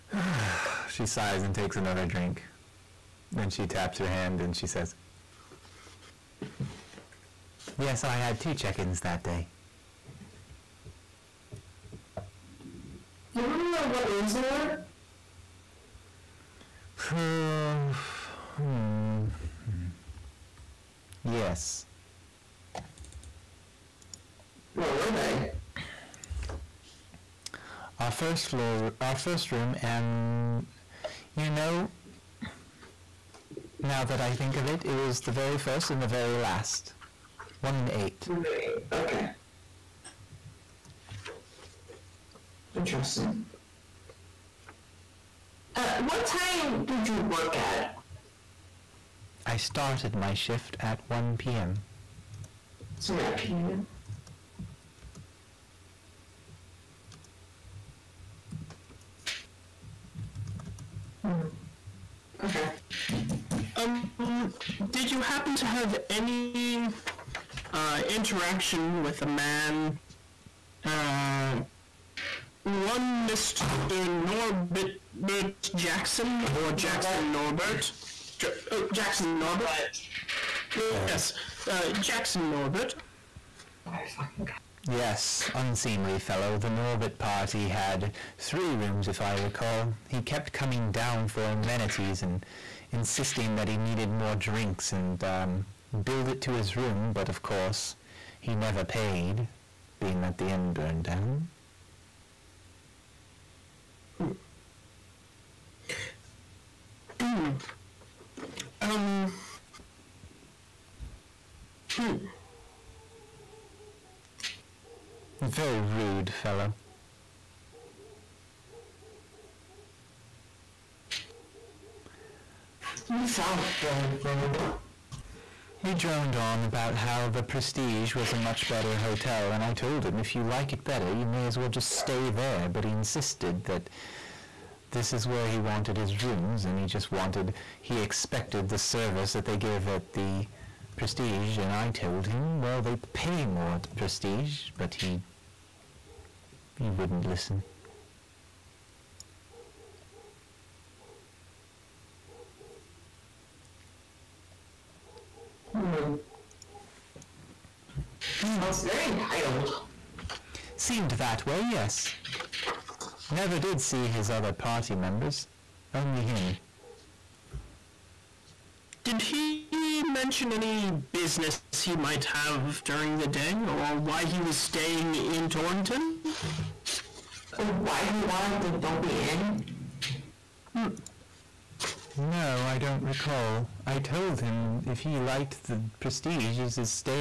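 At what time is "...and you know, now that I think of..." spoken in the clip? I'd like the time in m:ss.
0:29.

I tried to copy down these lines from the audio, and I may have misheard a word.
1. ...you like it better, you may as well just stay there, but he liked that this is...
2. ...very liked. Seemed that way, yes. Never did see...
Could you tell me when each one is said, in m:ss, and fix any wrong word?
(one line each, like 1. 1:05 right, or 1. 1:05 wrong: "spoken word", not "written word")
1. 2:10 wrong: "insisted", not "liked"
2. 2:38 wrong: "entitled", not "liked".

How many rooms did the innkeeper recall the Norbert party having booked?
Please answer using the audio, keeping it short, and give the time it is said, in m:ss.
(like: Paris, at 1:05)
3, at 1:28.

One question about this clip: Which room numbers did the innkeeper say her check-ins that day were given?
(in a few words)
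1 and 8.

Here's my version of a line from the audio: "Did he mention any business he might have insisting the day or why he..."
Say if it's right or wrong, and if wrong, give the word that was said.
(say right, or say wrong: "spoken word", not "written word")
wrong: "during", not "insisting".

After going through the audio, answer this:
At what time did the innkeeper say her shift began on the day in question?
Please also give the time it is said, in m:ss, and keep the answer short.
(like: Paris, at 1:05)
1 p.m., at 0:51.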